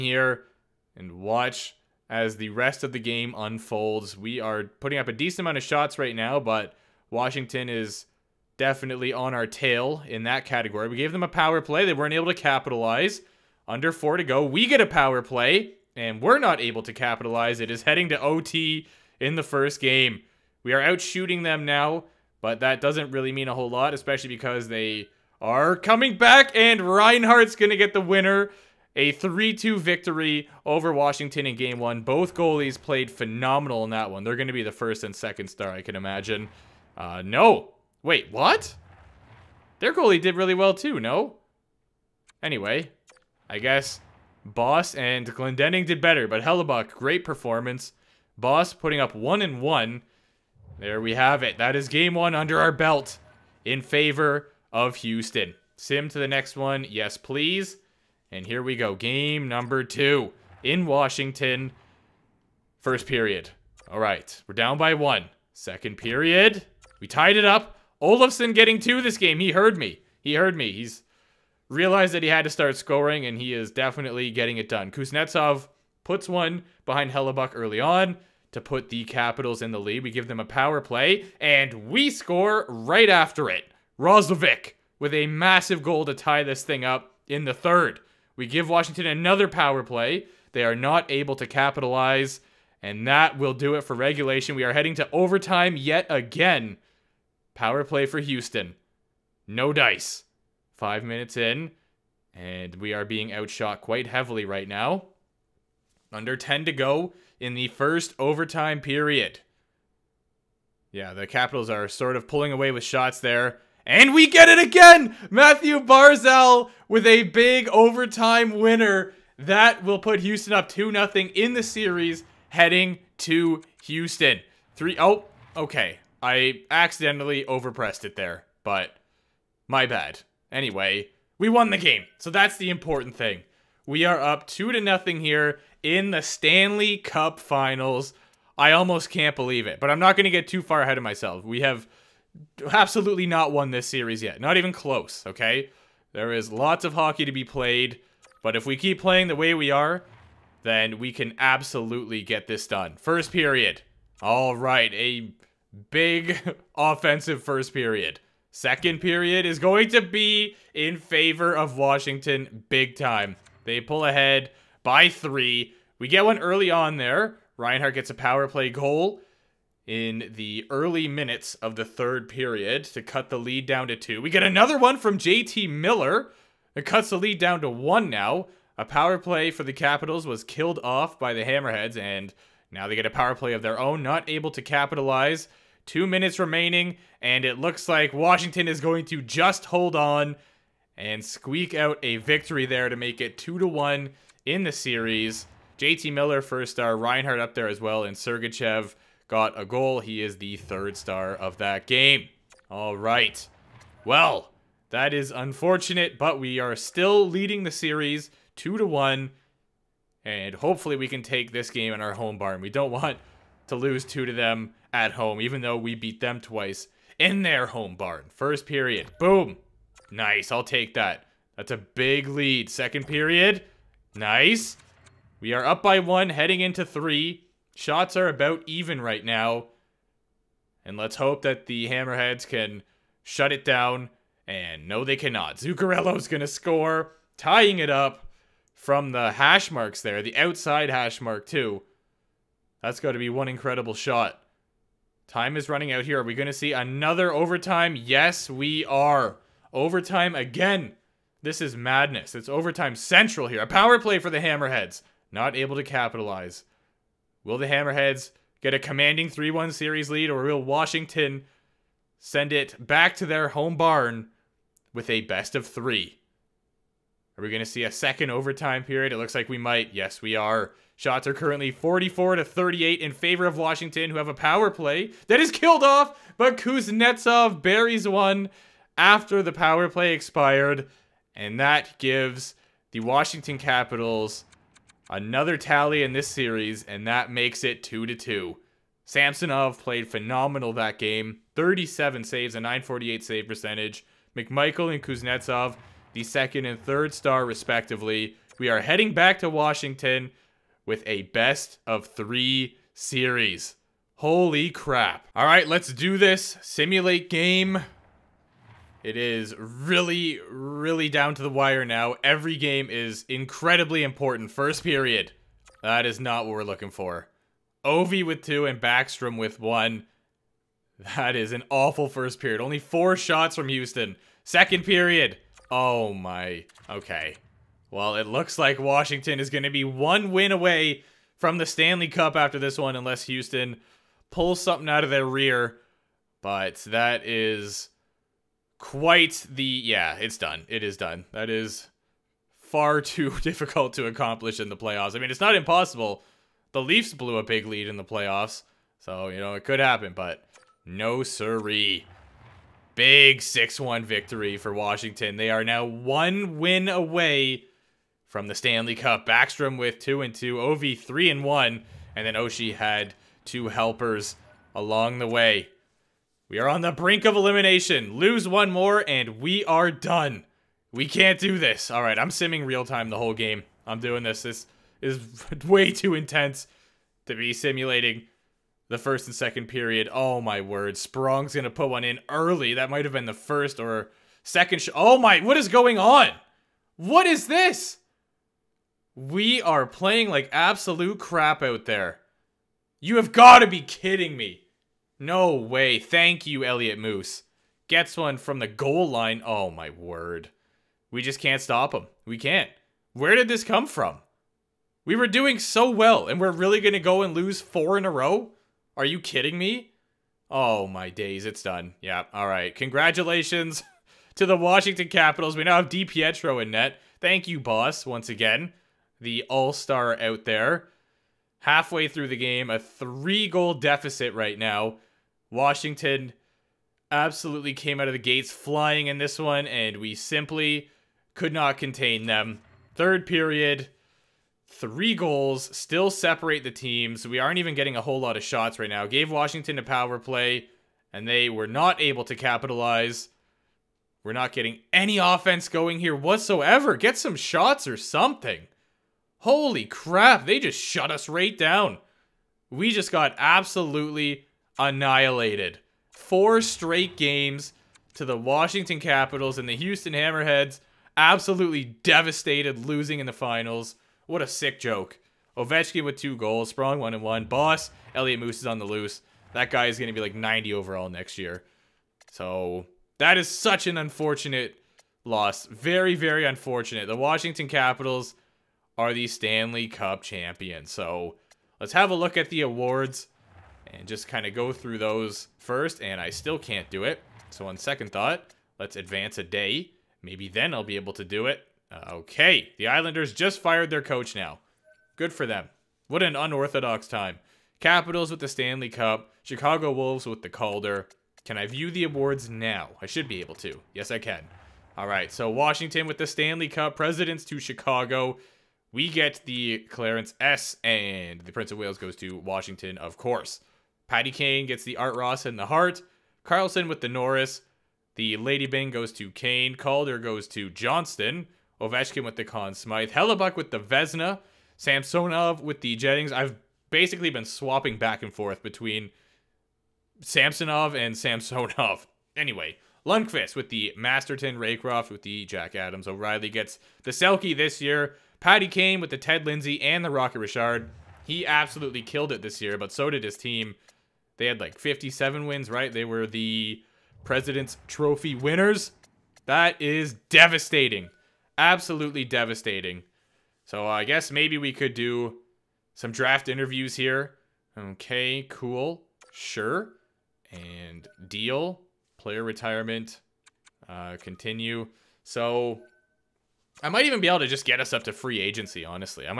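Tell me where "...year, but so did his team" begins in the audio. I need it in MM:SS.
09:02.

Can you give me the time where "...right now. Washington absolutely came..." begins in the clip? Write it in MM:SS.
07:04.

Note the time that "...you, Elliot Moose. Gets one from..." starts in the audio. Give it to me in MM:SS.
06:36.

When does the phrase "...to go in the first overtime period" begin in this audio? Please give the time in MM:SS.
01:46.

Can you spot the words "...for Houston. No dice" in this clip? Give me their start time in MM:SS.
01:38.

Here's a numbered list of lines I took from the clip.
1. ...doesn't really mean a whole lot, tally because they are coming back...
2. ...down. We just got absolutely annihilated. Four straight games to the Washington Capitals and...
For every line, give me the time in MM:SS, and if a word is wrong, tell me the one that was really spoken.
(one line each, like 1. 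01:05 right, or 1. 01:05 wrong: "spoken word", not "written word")
1. 00:22 wrong: "especially", not "tally"
2. 07:31 right.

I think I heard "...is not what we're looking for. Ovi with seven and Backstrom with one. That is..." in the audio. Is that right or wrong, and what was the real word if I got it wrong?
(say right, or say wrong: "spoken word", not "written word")
wrong: "two", not "seven".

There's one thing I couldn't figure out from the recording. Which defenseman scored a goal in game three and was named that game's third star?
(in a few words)
Sergachev.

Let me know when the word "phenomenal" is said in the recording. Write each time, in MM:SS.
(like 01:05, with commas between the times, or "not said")
00:33, 04:50.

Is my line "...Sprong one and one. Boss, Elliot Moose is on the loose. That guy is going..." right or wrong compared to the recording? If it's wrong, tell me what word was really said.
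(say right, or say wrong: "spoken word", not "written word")
right.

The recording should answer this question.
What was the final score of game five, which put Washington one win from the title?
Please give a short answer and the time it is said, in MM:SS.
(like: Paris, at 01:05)
6-1, at 05:53.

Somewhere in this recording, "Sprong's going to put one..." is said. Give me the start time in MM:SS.
06:20.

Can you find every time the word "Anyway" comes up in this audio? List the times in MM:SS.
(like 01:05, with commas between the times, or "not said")
00:42, 02:10, 08:52.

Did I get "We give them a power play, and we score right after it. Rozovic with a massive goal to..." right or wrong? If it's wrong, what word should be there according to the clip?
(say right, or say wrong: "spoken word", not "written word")
right.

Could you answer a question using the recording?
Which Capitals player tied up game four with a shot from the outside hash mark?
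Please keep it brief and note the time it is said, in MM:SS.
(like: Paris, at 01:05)
Zuccarello, at 03:55.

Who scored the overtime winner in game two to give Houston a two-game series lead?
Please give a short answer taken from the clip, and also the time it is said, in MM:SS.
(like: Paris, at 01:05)
Mathew Barzal, at 01:55.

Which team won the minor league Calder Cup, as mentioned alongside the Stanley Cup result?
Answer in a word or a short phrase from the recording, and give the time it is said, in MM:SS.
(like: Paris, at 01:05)
Chicago Wolves, at 08:19.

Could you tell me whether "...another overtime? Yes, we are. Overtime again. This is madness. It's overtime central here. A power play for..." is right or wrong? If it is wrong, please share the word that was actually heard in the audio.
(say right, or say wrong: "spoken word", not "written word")
right.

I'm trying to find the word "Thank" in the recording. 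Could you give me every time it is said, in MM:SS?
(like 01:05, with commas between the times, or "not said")
06:35, 06:57.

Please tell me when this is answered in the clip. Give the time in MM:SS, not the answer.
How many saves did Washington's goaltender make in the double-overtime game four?
04:51.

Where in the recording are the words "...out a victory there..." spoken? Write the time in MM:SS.
03:11.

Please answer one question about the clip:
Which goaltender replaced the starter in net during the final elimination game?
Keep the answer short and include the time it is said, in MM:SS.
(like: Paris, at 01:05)
DiPietro, at 06:55.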